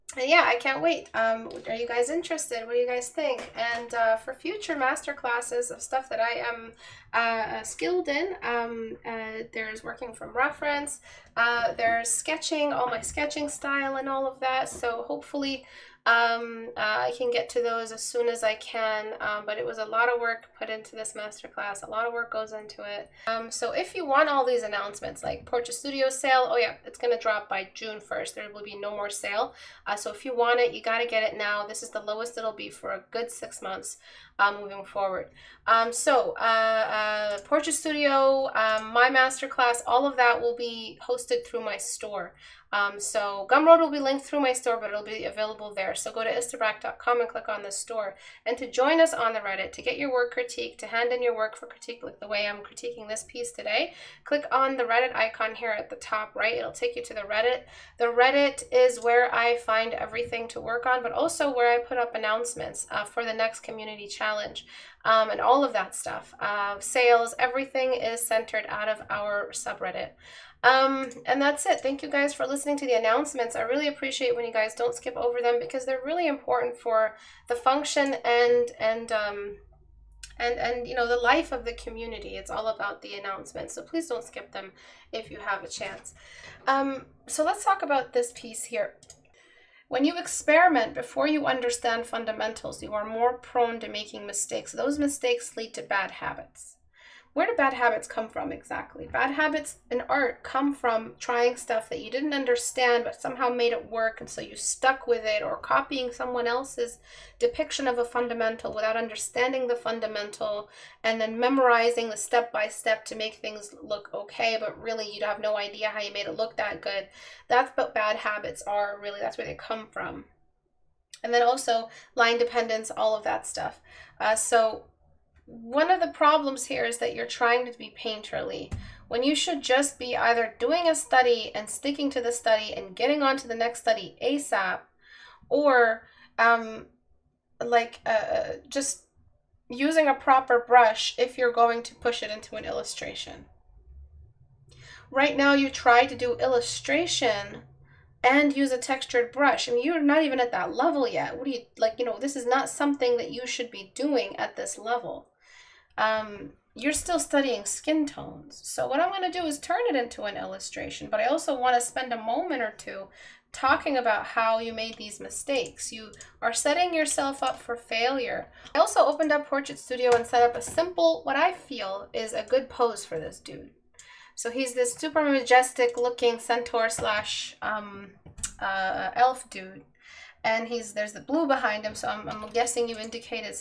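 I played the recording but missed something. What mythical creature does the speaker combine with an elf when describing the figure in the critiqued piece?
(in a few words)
centaur.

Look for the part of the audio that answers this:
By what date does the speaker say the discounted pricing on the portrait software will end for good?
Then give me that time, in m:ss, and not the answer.
0:27.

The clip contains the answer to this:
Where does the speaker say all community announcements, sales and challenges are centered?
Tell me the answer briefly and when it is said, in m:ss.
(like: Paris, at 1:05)
subreddit, at 1:09.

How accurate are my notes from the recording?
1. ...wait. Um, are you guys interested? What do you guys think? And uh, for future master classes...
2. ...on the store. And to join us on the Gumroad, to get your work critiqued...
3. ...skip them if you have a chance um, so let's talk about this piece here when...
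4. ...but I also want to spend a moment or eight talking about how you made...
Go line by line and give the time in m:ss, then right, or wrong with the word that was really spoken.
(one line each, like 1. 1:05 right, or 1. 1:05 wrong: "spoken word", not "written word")
1. 0:00 right
2. 0:47 wrong: "Reddit", not "Gumroad"
3. 1:24 right
4. 2:41 wrong: "two", not "eight".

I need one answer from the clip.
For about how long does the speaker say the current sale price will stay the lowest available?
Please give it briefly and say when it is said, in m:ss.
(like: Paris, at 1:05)
6 months, at 0:33.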